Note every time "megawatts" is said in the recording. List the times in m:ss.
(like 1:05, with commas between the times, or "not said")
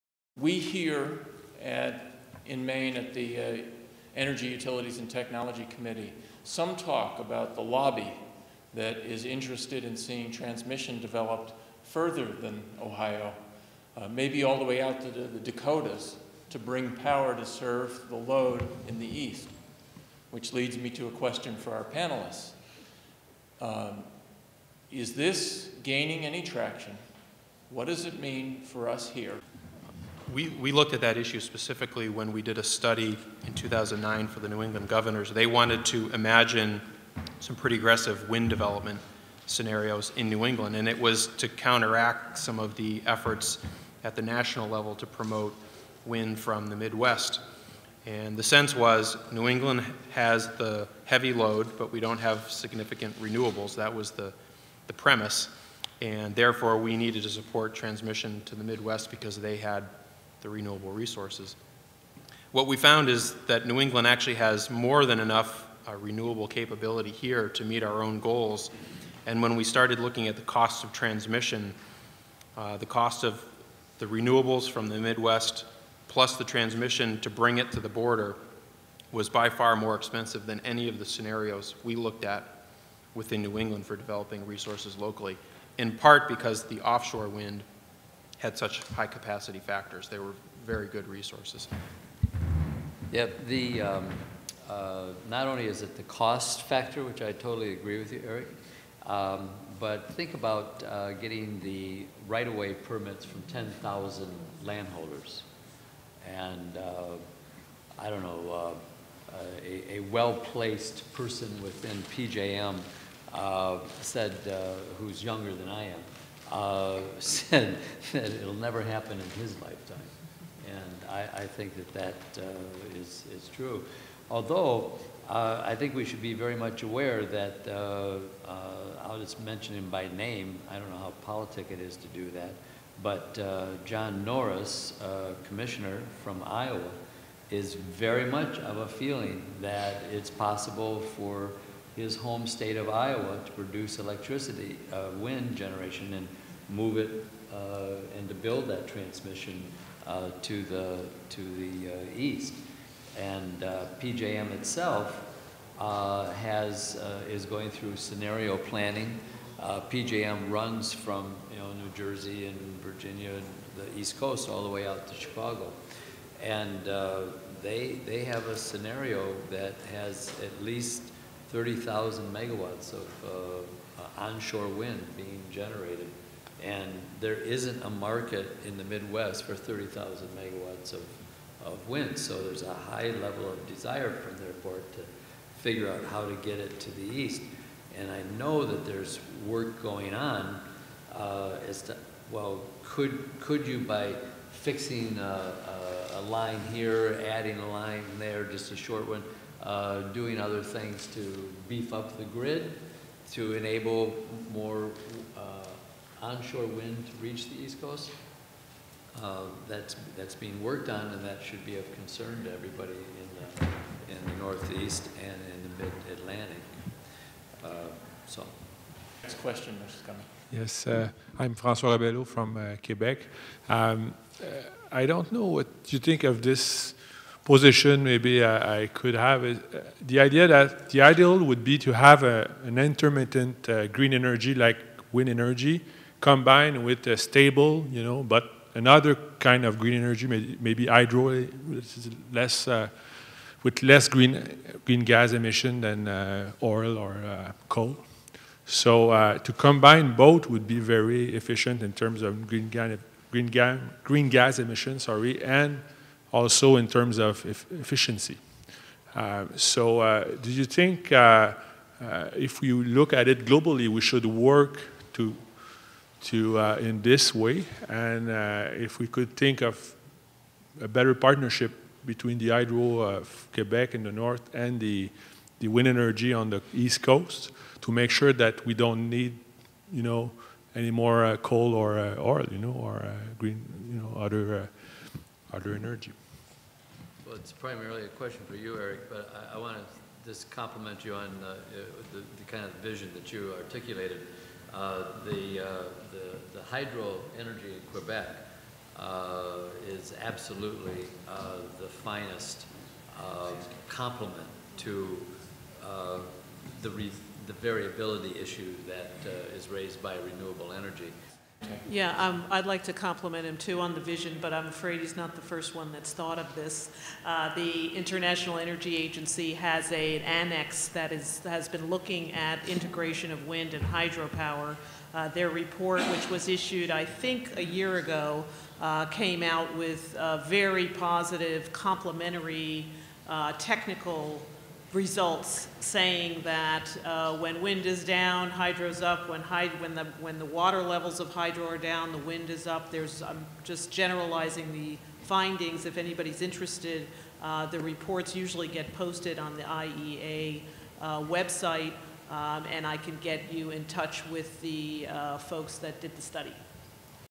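2:52, 3:00.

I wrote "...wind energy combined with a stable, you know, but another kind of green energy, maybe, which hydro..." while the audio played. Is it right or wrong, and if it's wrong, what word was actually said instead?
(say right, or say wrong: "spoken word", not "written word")
right.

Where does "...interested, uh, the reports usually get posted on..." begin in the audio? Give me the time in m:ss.
5:46.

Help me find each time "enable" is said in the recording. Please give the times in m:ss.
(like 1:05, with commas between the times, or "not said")
3:23.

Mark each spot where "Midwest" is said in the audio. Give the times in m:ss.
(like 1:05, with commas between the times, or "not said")
0:46, 0:58, 1:14, 2:58.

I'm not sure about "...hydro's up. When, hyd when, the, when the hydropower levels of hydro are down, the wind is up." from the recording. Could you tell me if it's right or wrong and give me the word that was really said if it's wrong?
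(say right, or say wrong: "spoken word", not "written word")
wrong: "water", not "hydropower".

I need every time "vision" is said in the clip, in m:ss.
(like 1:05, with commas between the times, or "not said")
4:52, 5:13.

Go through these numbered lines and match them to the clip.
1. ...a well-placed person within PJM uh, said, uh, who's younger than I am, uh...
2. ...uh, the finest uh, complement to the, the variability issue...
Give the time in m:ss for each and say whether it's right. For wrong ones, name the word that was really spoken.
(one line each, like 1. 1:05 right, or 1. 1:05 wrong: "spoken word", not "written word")
1. 1:49 right
2. 5:01 right.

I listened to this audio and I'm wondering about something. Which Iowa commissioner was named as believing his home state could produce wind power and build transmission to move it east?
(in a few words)
John Norris.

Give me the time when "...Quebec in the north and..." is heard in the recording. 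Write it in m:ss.
4:33.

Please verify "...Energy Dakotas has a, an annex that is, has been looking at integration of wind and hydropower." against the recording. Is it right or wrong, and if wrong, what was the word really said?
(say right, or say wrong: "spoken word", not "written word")
wrong: "Agency", not "Dakotas".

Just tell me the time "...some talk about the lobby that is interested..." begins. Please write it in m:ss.
0:06.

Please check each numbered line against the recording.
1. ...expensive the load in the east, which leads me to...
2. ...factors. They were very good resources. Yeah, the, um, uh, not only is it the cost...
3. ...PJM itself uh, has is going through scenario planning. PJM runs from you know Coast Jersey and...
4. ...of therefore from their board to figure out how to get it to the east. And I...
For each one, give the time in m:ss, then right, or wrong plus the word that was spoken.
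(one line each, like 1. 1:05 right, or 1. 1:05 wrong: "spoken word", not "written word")
1. 0:17 wrong: "serve", not "expensive"
2. 1:29 right
3. 2:34 wrong: "New", not "Coast"
4. 3:03 wrong: "desire", not "therefore".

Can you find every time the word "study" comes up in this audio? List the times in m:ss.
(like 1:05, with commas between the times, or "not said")
0:32, 5:56.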